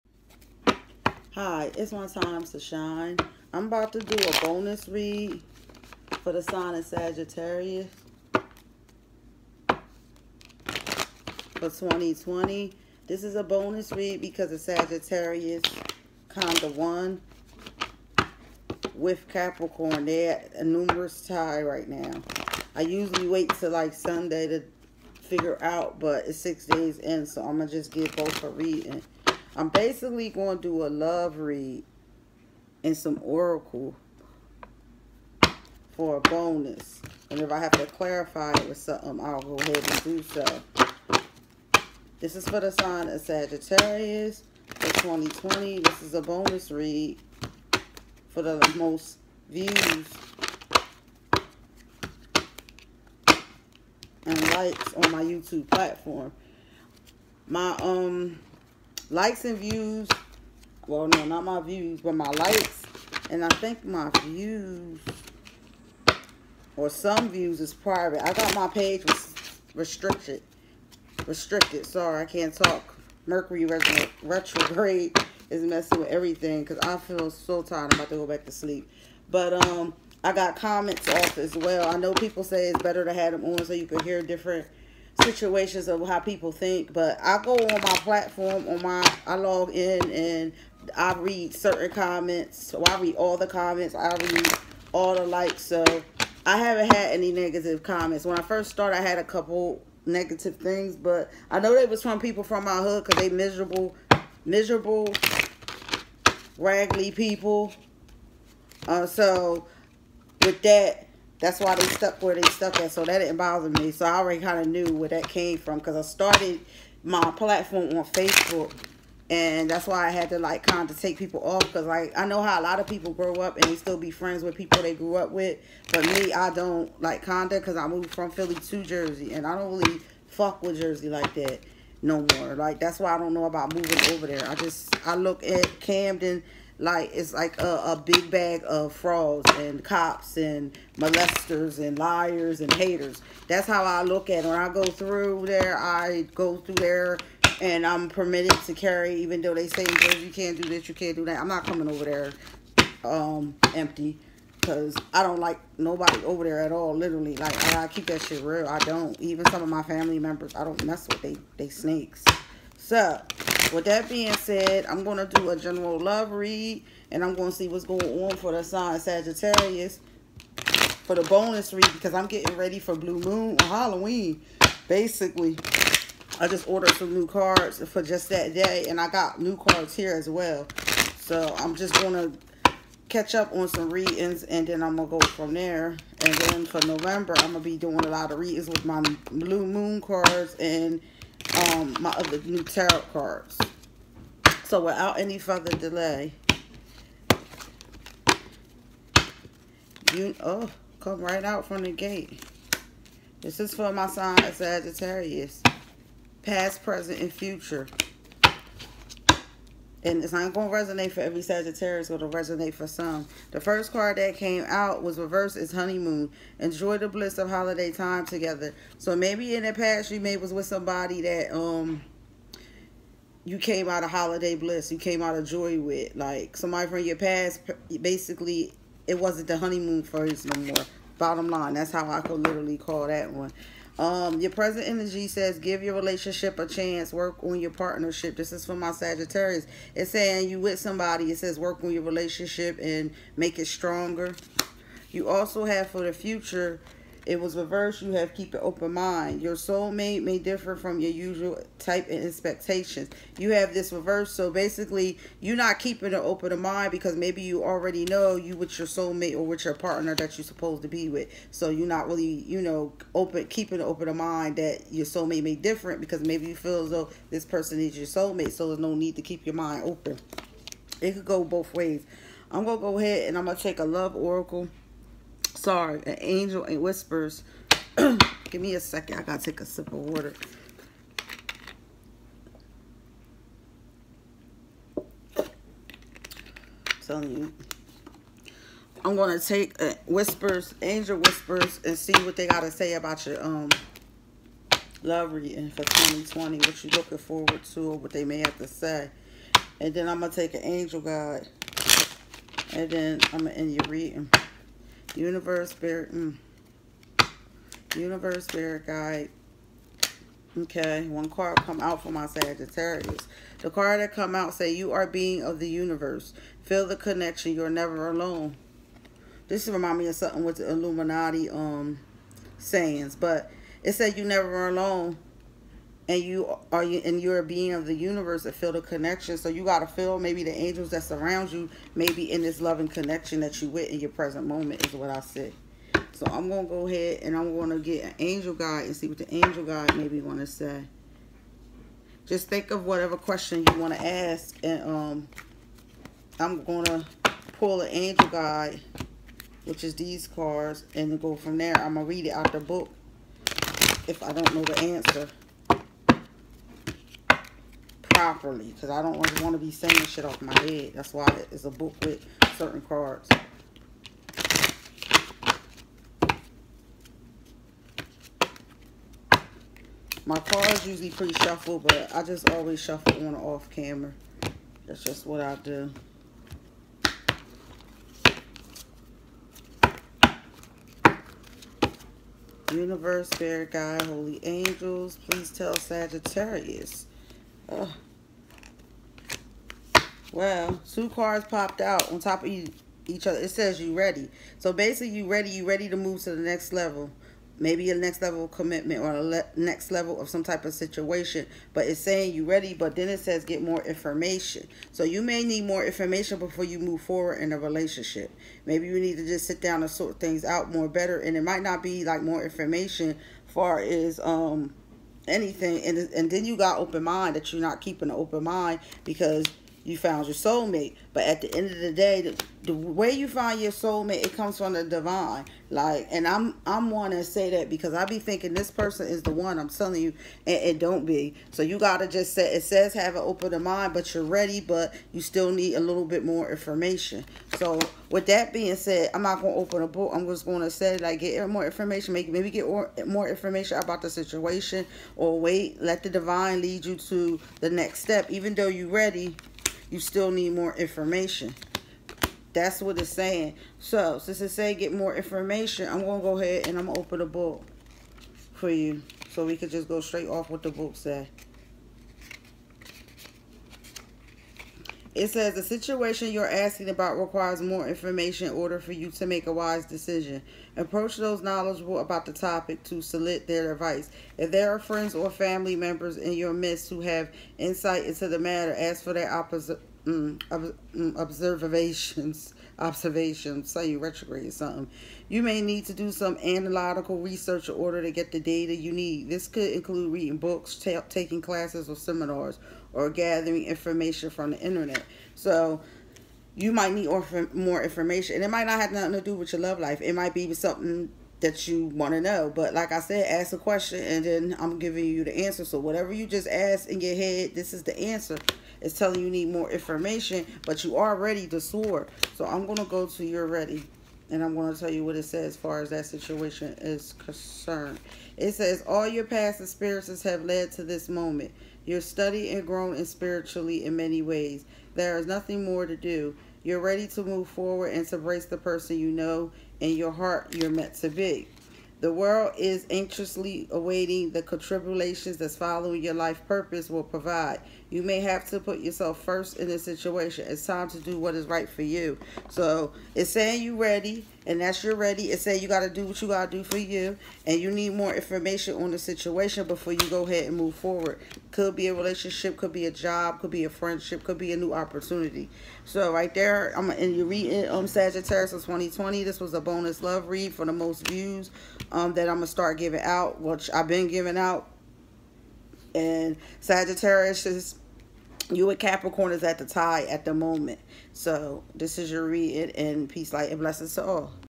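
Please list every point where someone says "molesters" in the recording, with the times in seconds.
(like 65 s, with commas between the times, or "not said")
140 s.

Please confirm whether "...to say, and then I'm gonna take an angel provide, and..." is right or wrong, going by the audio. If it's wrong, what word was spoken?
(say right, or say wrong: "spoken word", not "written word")
wrong: "guide", not "provide".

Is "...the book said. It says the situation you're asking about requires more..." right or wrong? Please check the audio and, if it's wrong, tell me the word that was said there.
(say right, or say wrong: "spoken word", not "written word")
right.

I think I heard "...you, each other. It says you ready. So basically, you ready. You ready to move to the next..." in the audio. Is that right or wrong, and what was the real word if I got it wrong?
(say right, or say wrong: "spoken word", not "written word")
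right.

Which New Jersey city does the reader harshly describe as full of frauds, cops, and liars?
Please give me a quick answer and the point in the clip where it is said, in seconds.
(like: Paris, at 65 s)
Camden, at 135 s.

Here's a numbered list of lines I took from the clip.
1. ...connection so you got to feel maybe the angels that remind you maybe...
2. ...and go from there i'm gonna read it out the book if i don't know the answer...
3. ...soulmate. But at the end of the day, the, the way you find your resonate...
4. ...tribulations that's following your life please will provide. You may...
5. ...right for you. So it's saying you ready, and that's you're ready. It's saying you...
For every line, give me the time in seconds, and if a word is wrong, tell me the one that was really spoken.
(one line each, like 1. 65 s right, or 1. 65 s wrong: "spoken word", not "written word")
1. 328 s wrong: "surround", not "remind"
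2. 350 s right
3. 420 s wrong: "soulmate", not "resonate"
4. 534 s wrong: "purpose", not "please"
5. 541 s right.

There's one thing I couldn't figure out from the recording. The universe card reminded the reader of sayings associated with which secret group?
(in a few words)
Illuminati.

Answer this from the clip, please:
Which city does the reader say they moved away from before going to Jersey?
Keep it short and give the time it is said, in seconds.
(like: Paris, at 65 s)
Philly, at 128 s.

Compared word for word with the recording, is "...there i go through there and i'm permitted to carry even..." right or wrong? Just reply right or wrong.
right.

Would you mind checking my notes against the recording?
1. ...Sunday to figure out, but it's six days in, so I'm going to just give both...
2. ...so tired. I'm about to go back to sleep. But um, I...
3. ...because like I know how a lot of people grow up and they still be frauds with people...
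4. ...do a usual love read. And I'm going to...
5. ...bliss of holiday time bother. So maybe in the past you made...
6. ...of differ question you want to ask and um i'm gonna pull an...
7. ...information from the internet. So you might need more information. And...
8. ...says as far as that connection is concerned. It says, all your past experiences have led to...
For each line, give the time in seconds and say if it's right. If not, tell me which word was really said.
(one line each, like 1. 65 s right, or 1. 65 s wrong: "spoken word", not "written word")
1. 23 s right
2. 77 s right
3. 121 s wrong: "friends", not "frauds"
4. 165 s wrong: "general", not "usual"
5. 217 s wrong: "together", not "bother"
6. 342 s wrong: "whatever", not "differ"
7. 493 s right
8. 515 s wrong: "situation", not "connection".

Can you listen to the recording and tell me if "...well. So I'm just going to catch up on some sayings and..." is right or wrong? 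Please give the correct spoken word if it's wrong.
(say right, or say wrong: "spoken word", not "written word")
wrong: "readings", not "sayings".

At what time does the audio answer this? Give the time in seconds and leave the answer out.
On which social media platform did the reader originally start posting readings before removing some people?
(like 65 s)
118 s.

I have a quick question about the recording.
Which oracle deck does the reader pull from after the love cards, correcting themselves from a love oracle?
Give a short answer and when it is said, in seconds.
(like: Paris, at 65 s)
Angel Whispers, at 290 s.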